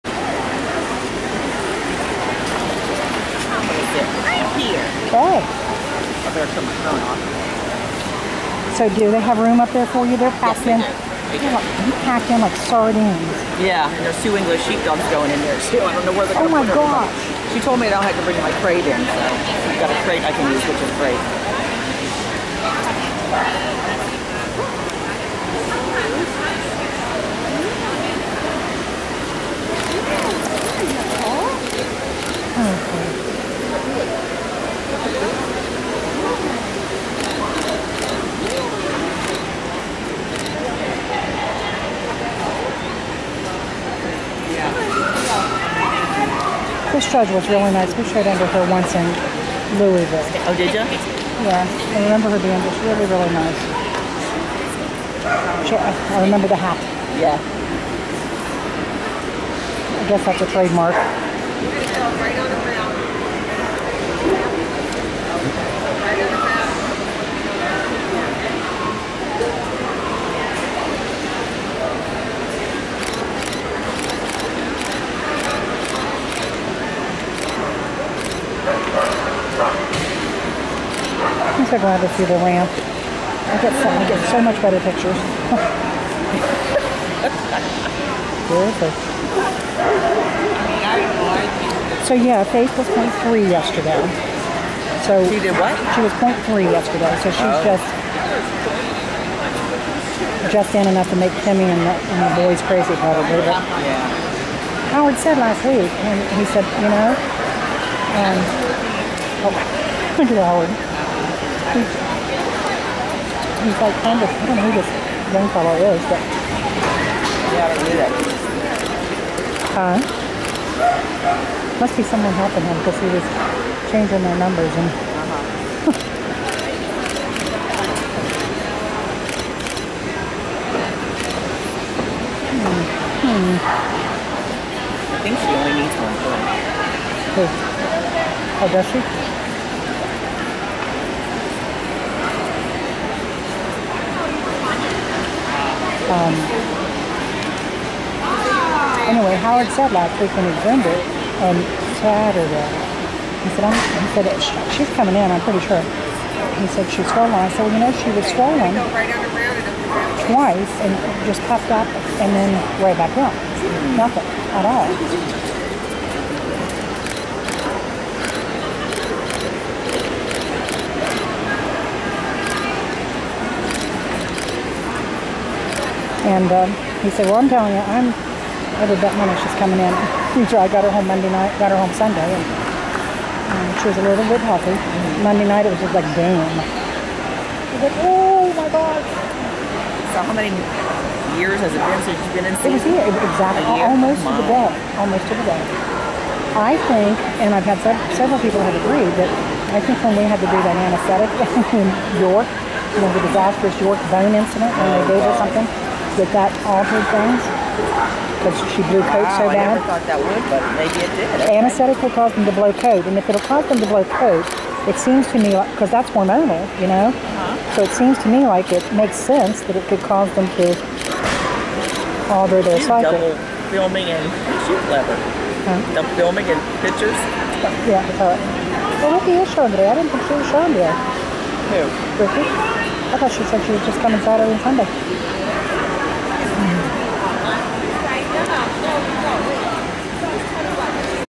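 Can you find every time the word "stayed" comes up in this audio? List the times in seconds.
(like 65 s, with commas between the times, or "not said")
48 s.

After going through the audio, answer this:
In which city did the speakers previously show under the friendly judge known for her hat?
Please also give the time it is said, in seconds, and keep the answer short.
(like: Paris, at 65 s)
Louisville, at 49 s.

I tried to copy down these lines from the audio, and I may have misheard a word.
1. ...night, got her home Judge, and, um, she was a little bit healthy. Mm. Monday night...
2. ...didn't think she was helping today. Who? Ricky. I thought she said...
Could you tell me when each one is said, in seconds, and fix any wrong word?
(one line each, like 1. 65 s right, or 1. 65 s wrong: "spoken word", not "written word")
1. 181 s wrong: "Sunday", not "Judge"
2. 229 s wrong: "showing", not "helping".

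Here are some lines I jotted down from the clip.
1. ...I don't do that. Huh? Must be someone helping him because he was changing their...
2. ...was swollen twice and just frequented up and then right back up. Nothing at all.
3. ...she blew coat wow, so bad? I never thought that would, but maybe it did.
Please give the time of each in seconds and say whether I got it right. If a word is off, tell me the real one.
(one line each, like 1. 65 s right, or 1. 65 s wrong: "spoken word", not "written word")
1. 117 s right
2. 158 s wrong: "puffed", not "frequented"
3. 208 s right.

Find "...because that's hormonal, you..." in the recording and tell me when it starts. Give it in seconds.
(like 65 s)
215 s.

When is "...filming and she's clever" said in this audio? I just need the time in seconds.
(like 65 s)
223 s.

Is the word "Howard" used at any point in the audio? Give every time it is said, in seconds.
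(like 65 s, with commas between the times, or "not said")
104 s, 110 s, 149 s.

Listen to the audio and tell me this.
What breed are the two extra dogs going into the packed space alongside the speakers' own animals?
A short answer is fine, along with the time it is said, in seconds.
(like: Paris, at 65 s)
English sheepdogs, at 14 s.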